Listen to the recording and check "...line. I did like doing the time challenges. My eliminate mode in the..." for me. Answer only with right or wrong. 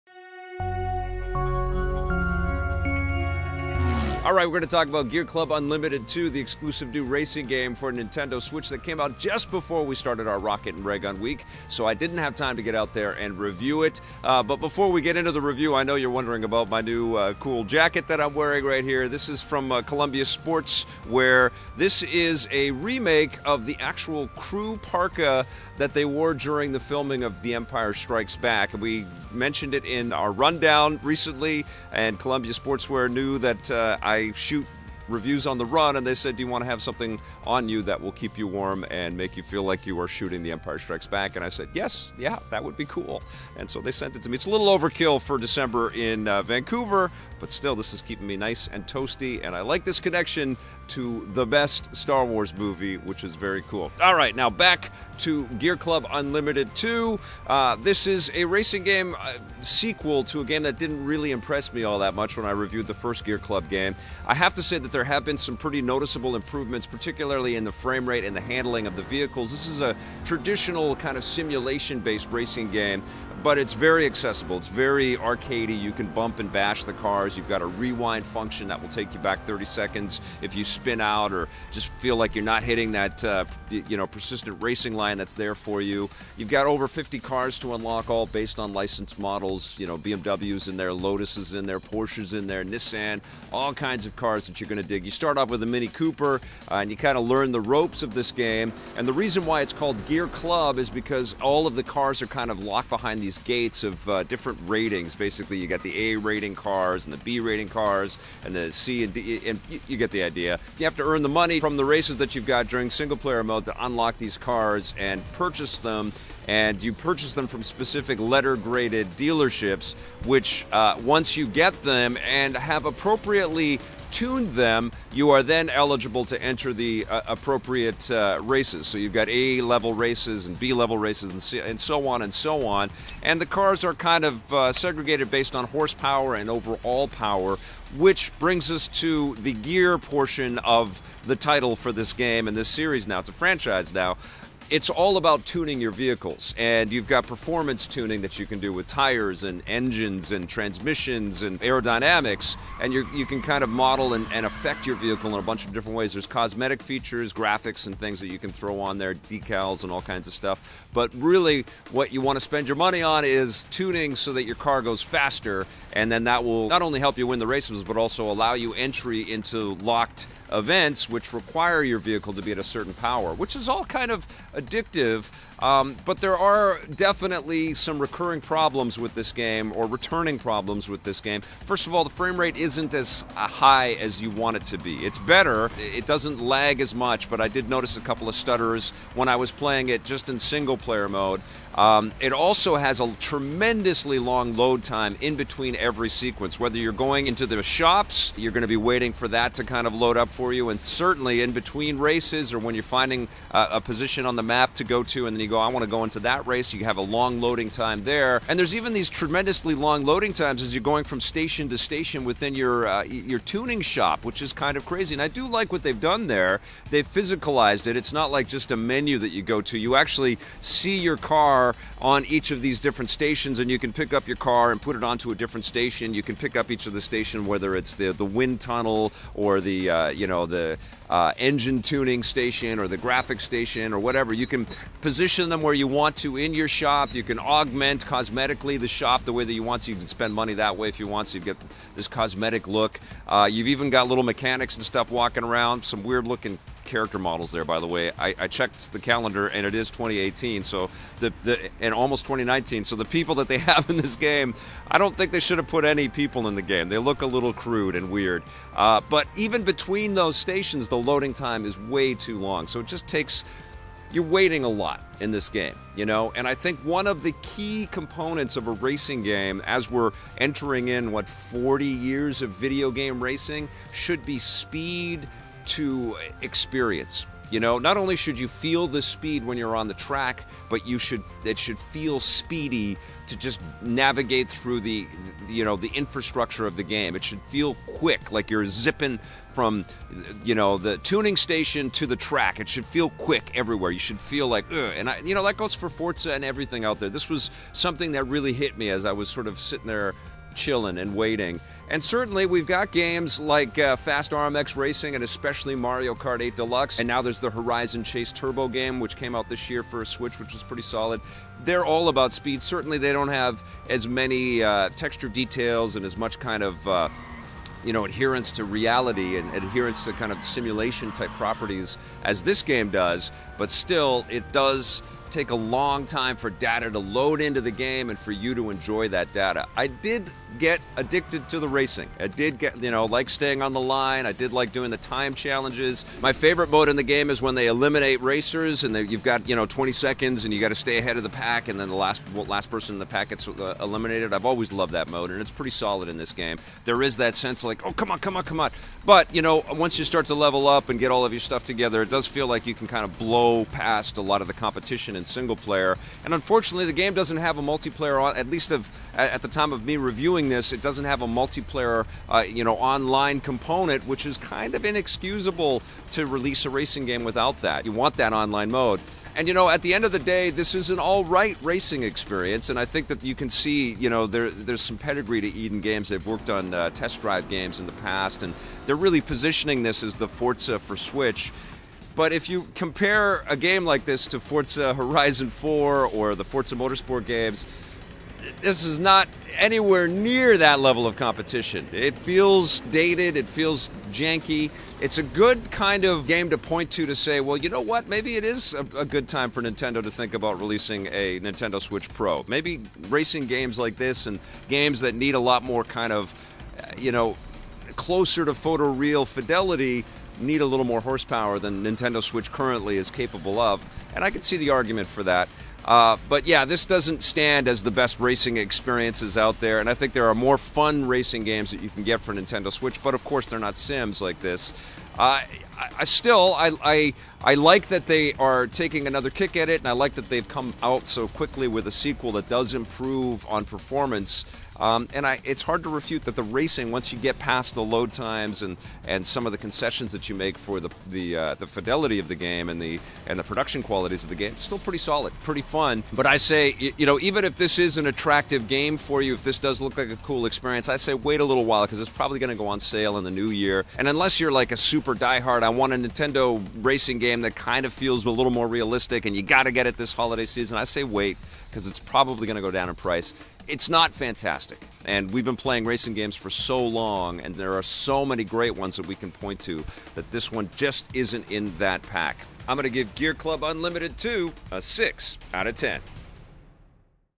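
wrong.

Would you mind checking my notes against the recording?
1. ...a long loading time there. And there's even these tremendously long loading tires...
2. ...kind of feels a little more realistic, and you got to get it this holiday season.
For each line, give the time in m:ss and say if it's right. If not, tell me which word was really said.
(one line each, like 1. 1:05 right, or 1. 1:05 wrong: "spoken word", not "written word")
1. 3:26 wrong: "times", not "tires"
2. 7:37 right.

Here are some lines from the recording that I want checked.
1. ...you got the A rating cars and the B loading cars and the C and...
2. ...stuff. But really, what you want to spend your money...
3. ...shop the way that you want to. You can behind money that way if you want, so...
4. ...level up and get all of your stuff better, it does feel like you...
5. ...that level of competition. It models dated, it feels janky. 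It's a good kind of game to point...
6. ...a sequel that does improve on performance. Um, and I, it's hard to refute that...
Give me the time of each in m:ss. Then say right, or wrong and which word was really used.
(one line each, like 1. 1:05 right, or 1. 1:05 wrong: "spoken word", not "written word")
1. 1:45 wrong: "rating", not "loading"
2. 2:40 right
3. 3:58 wrong: "spend", not "behind"
4. 5:50 wrong: "together", not "better"
5. 6:30 wrong: "feels", not "models"
6. 7:11 right.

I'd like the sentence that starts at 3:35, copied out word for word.
And I do like what they've done there.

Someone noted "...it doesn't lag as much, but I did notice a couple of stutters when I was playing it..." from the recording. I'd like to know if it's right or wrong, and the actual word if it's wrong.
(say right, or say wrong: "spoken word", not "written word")
right.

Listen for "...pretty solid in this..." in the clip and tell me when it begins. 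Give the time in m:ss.
5:45.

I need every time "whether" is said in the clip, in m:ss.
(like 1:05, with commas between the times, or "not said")
3:16, 3:47.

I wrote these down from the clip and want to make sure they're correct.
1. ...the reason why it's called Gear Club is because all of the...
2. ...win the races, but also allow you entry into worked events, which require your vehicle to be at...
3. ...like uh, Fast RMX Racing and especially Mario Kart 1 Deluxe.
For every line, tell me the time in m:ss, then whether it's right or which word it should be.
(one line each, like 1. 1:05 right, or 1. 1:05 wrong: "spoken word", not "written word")
1. 1:39 right
2. 2:47 wrong: "locked", not "worked"
3. 5:03 wrong: "8", not "1".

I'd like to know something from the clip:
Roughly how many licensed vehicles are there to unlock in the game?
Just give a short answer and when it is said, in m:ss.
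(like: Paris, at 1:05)
over 50, at 1:26.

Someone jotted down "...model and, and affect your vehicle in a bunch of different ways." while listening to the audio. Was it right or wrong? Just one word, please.
right.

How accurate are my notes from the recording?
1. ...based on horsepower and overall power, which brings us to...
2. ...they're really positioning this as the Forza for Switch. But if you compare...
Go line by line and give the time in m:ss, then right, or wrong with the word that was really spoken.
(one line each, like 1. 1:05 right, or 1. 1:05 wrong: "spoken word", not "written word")
1. 2:15 right
2. 6:18 right.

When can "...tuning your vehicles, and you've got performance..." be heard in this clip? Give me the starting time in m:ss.
2:25.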